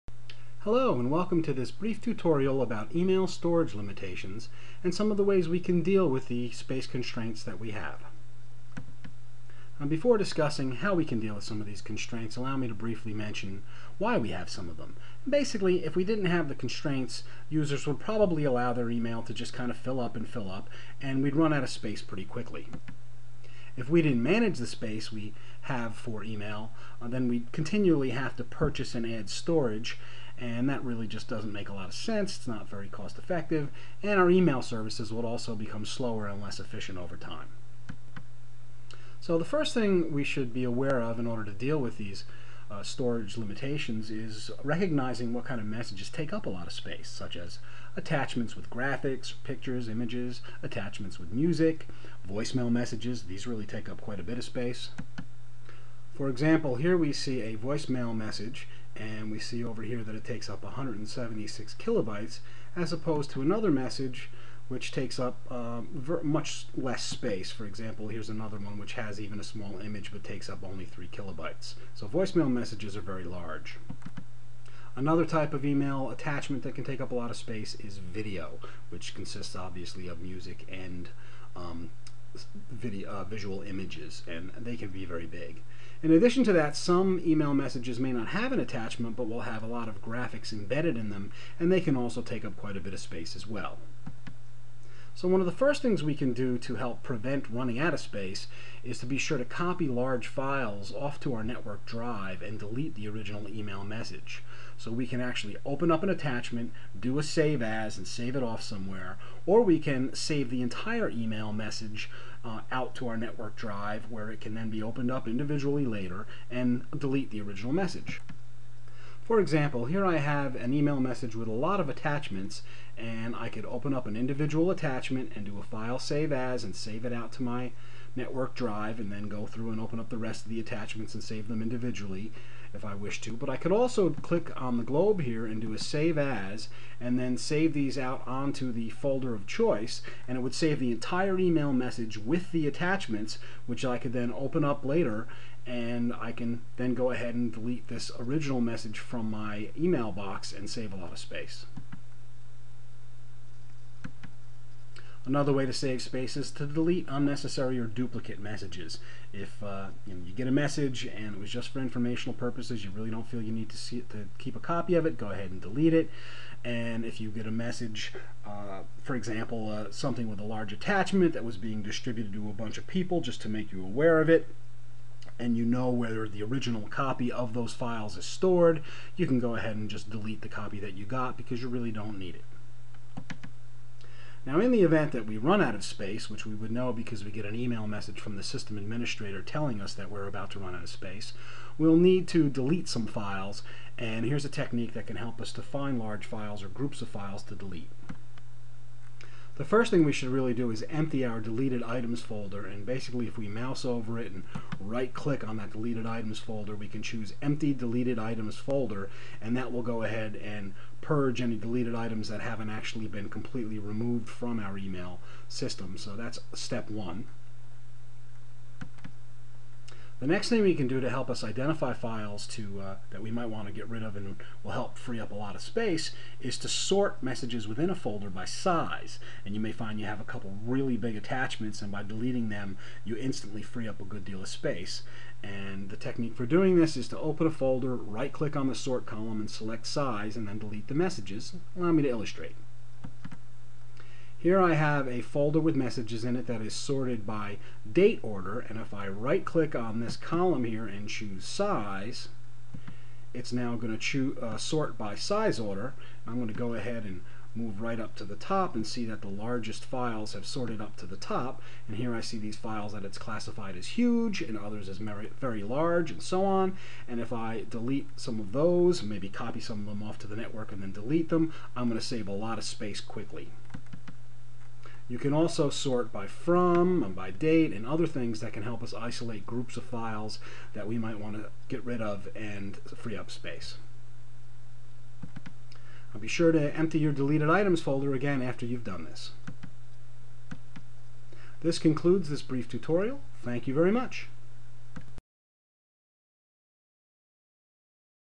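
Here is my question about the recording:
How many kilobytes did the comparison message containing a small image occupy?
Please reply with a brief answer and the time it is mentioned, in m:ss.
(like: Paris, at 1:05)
3 kilobytes, at 1:10.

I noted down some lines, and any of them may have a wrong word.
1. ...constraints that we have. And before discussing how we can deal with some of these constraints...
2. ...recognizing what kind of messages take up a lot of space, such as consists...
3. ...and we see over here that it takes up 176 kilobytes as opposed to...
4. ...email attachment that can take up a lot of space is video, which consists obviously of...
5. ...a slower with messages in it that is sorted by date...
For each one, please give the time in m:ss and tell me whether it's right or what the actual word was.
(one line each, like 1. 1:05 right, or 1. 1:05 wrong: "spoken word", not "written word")
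1. 0:06 right
2. 0:44 wrong: "attachments", not "consists"
3. 0:58 right
4. 1:15 right
5. 4:05 wrong: "folder", not "slower".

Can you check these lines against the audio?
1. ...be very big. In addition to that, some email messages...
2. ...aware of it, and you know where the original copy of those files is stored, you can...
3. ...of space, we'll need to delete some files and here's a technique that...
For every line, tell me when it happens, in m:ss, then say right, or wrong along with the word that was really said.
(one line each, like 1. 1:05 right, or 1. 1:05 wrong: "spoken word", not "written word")
1. 1:24 right
2. 2:53 right
3. 3:10 right.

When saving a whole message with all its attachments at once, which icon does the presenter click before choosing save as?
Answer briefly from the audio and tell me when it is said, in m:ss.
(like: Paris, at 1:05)
the globe, at 2:14.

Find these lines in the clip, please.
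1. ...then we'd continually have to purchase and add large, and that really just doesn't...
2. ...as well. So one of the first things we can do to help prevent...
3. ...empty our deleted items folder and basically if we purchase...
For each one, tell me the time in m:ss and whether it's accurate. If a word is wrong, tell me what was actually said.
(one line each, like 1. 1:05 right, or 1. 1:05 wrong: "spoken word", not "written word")
1. 0:27 wrong: "storage", not "large"
2. 1:33 right
3. 3:20 wrong: "mouse", not "purchase".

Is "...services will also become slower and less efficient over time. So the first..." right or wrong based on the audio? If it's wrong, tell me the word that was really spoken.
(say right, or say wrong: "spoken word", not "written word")
right.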